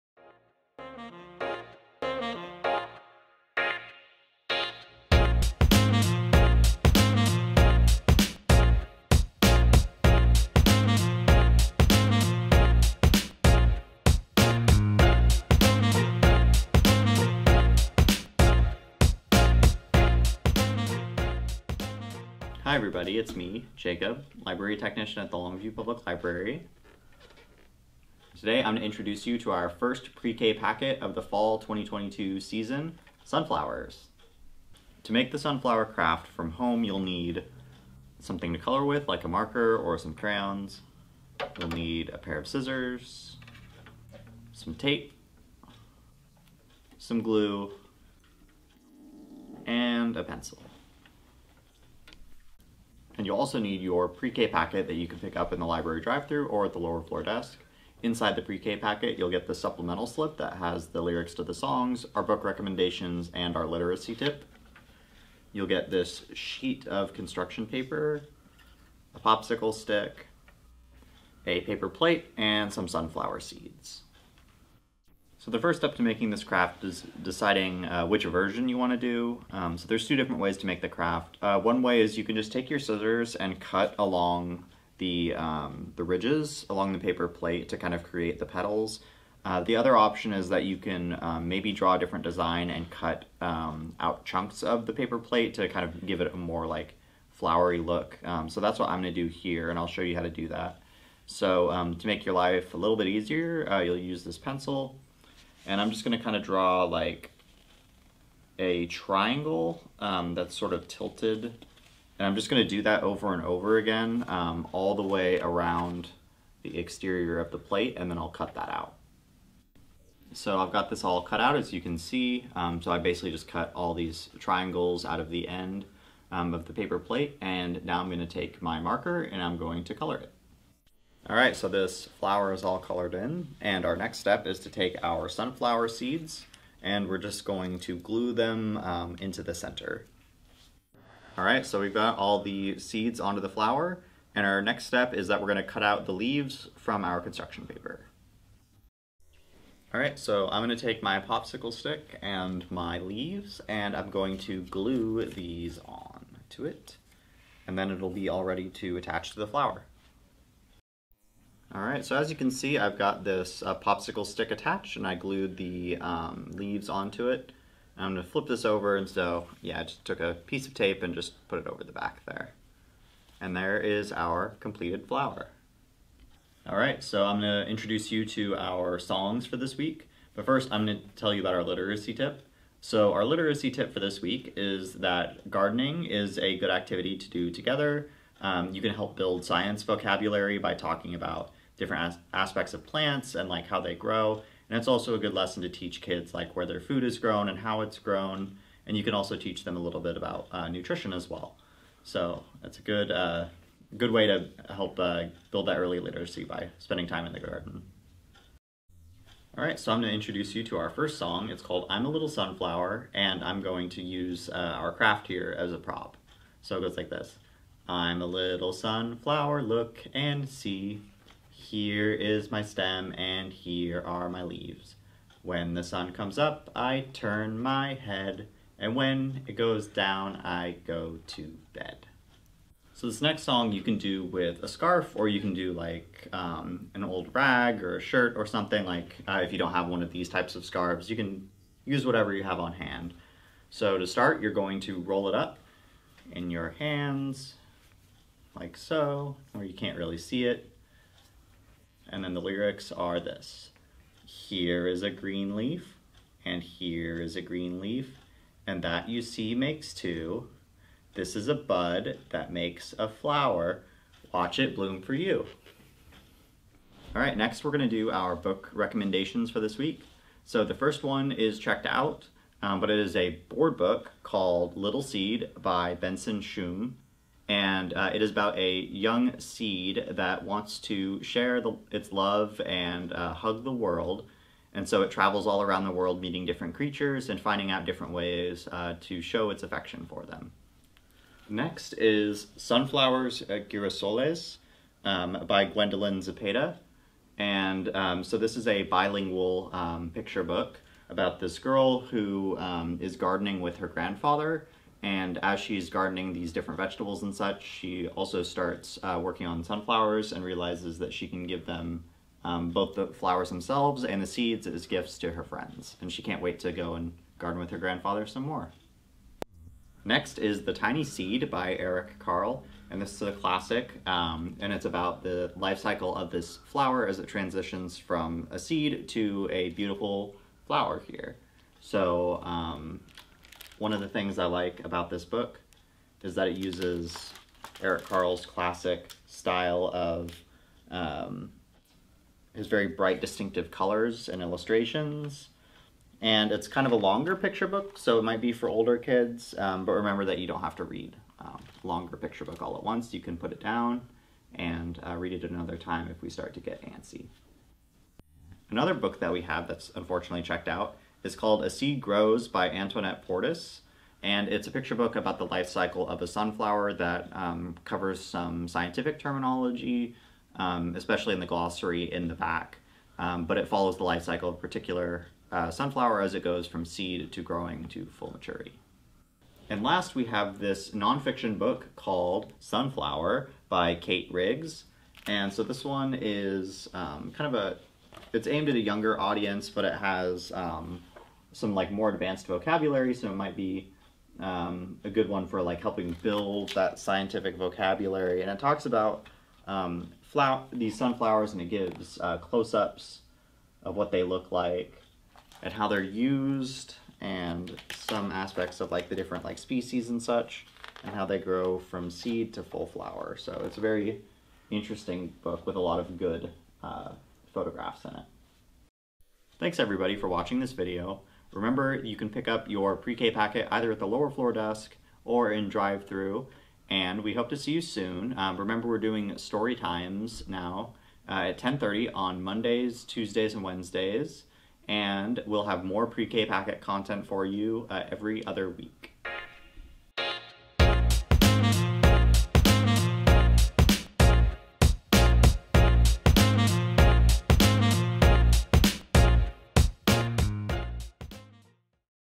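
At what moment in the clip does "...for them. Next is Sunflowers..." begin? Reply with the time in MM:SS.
04:50.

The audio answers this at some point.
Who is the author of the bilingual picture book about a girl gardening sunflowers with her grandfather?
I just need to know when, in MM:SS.
04:55.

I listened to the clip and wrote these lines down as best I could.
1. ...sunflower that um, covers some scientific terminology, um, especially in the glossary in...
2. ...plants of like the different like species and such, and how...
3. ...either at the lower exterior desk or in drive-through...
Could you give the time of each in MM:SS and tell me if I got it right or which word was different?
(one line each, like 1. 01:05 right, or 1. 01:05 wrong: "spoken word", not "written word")
1. 06:06 right
2. 06:48 wrong: "aspects", not "plants"
3. 07:03 wrong: "floor", not "exterior".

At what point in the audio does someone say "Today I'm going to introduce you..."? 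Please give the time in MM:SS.
00:28.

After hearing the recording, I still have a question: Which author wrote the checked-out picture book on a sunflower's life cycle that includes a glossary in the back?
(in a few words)
Antoinette Portis.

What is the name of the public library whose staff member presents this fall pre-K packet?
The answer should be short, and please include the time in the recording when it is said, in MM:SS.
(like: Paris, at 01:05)
Longview Public Library, at 00:25.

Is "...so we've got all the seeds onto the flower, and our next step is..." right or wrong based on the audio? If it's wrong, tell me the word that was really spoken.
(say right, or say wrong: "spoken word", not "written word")
right.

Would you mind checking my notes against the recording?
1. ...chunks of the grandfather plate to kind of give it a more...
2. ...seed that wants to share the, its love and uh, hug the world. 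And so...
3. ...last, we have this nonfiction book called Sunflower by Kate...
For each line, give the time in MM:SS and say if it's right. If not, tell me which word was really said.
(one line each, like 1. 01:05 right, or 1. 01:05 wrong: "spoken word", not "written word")
1. 01:34 wrong: "paper", not "grandfather"
2. 04:39 right
3. 06:19 right.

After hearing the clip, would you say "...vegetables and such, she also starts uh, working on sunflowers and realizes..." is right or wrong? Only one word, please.
right.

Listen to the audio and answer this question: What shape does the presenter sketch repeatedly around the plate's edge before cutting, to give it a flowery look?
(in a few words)
triangle.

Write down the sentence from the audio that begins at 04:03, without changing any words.
So to start, you're going to roll it up in your hands like so, where you can't really see it.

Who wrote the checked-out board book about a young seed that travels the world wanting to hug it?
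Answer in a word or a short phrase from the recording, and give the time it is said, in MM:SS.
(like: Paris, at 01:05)
Benson Shum, at 04:35.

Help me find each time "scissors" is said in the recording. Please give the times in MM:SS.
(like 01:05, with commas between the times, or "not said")
00:42, 01:22.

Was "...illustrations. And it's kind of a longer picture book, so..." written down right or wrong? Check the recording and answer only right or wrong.
right.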